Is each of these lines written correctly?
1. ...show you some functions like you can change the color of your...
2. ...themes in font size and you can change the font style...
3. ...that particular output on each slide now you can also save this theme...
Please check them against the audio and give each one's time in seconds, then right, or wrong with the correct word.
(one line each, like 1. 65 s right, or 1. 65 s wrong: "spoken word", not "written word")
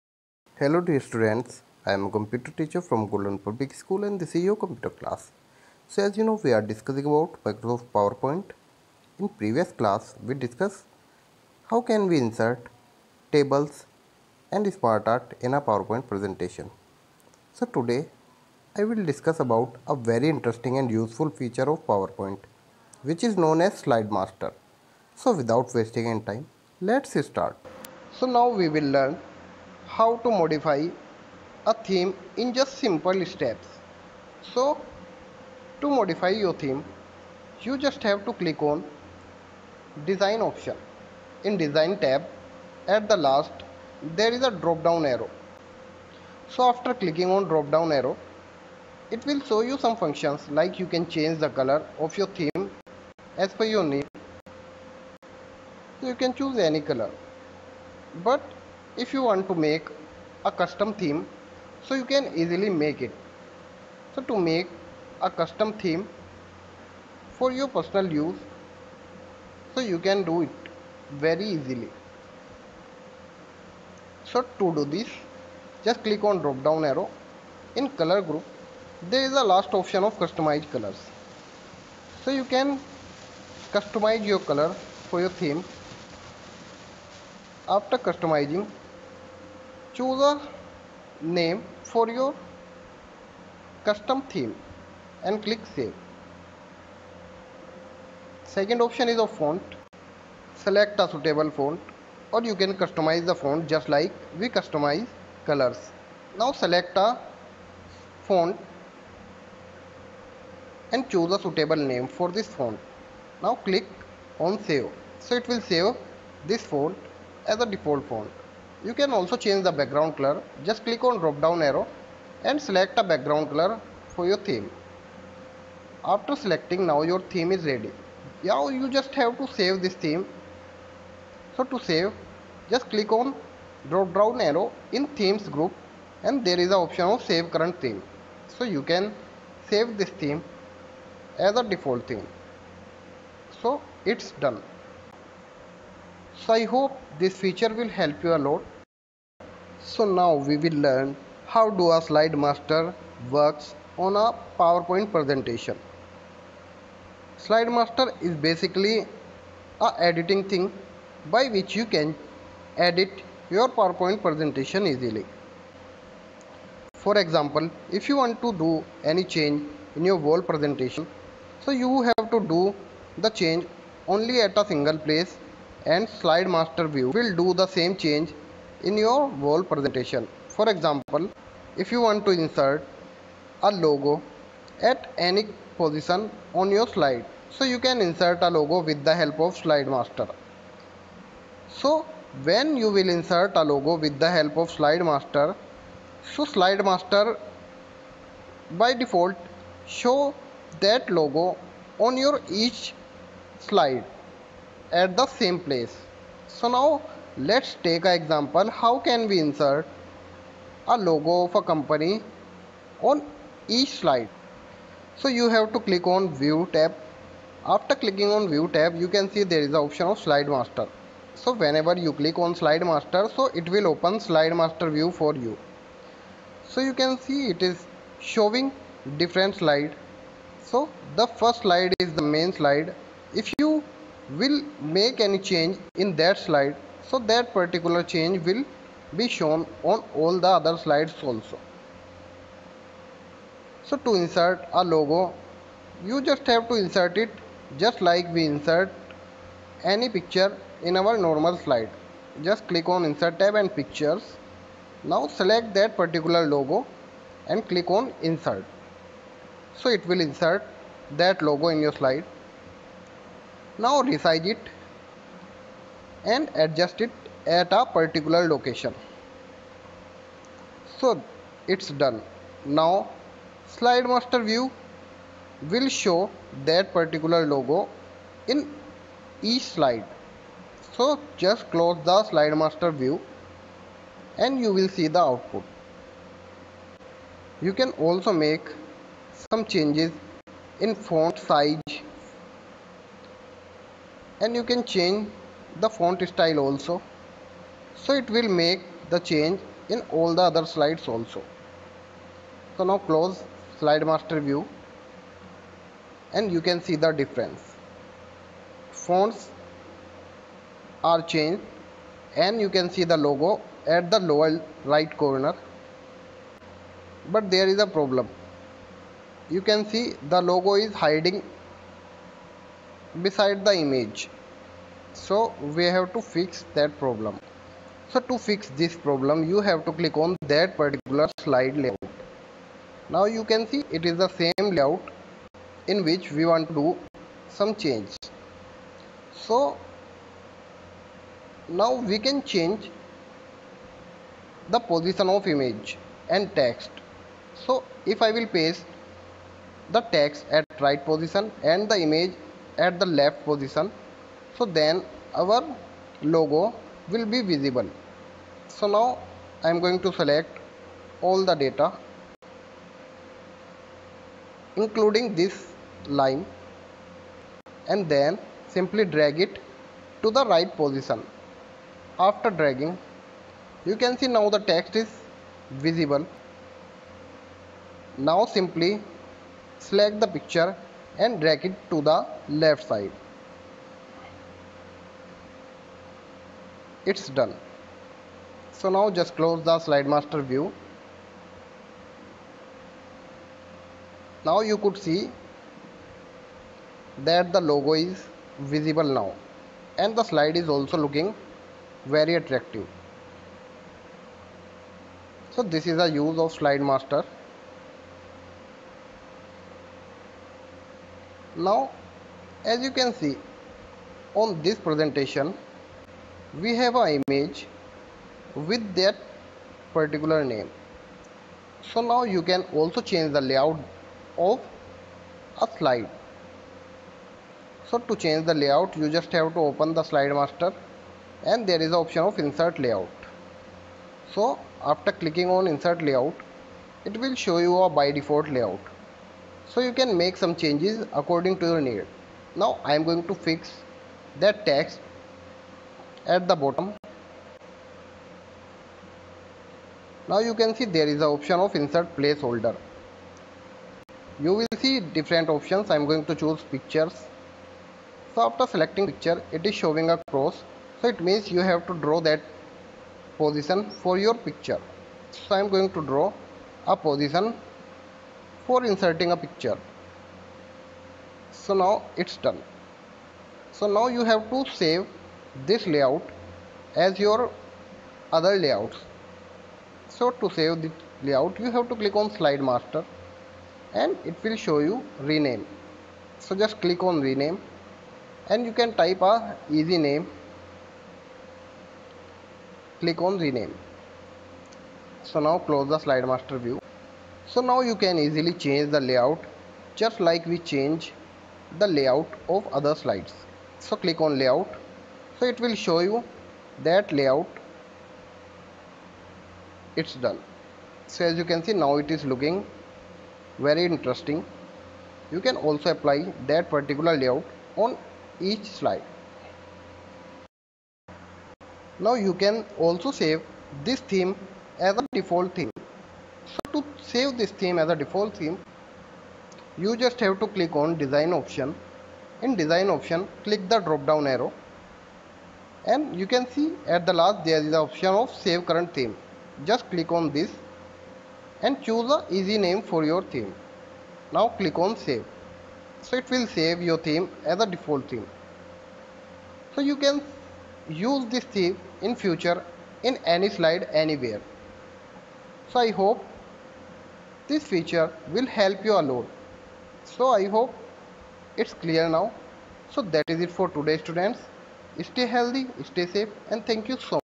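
1. 49 s right
2. 289 s wrong: "changes", not "themes"
3. 516 s wrong: "layout", not "output".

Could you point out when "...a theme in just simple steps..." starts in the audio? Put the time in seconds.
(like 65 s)
31 s.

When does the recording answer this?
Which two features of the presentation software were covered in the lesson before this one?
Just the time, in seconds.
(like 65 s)
13 s.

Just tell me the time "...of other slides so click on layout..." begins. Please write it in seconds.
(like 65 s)
502 s.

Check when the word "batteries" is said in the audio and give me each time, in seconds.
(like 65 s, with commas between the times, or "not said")
not said.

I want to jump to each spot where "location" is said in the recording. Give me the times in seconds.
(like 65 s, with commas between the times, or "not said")
268 s.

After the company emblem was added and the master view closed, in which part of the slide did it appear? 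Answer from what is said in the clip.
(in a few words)
lower right corner.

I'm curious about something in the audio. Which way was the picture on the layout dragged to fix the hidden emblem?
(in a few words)
left side.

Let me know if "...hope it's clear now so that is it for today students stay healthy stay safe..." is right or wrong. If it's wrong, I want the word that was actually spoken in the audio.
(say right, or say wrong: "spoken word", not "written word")
right.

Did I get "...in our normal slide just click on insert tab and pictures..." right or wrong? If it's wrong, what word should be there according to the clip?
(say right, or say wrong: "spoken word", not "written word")
right.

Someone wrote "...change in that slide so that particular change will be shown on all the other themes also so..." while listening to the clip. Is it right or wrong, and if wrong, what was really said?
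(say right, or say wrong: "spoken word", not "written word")
wrong: "slides", not "themes".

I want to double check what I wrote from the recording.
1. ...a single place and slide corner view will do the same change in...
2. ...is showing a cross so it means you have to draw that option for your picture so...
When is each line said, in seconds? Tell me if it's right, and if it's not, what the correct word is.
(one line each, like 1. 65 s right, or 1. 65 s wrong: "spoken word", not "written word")
1. 174 s wrong: "master", not "corner"
2. 459 s wrong: "position", not "option".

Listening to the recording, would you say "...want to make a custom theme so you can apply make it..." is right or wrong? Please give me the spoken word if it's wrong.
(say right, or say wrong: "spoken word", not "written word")
wrong: "easily", not "apply".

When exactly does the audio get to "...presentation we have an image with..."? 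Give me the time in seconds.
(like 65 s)
414 s.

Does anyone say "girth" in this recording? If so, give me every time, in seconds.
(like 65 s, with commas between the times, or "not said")
not said.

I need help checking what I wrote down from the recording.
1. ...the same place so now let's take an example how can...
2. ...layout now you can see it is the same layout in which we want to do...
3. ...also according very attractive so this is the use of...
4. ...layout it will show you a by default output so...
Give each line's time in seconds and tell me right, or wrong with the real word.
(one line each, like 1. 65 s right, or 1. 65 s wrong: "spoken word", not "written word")
1. 205 s right
2. 331 s right
3. 400 s wrong: "looking", not "according"
4. 436 s wrong: "layout", not "output".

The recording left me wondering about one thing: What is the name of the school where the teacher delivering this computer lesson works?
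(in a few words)
Golden Public School.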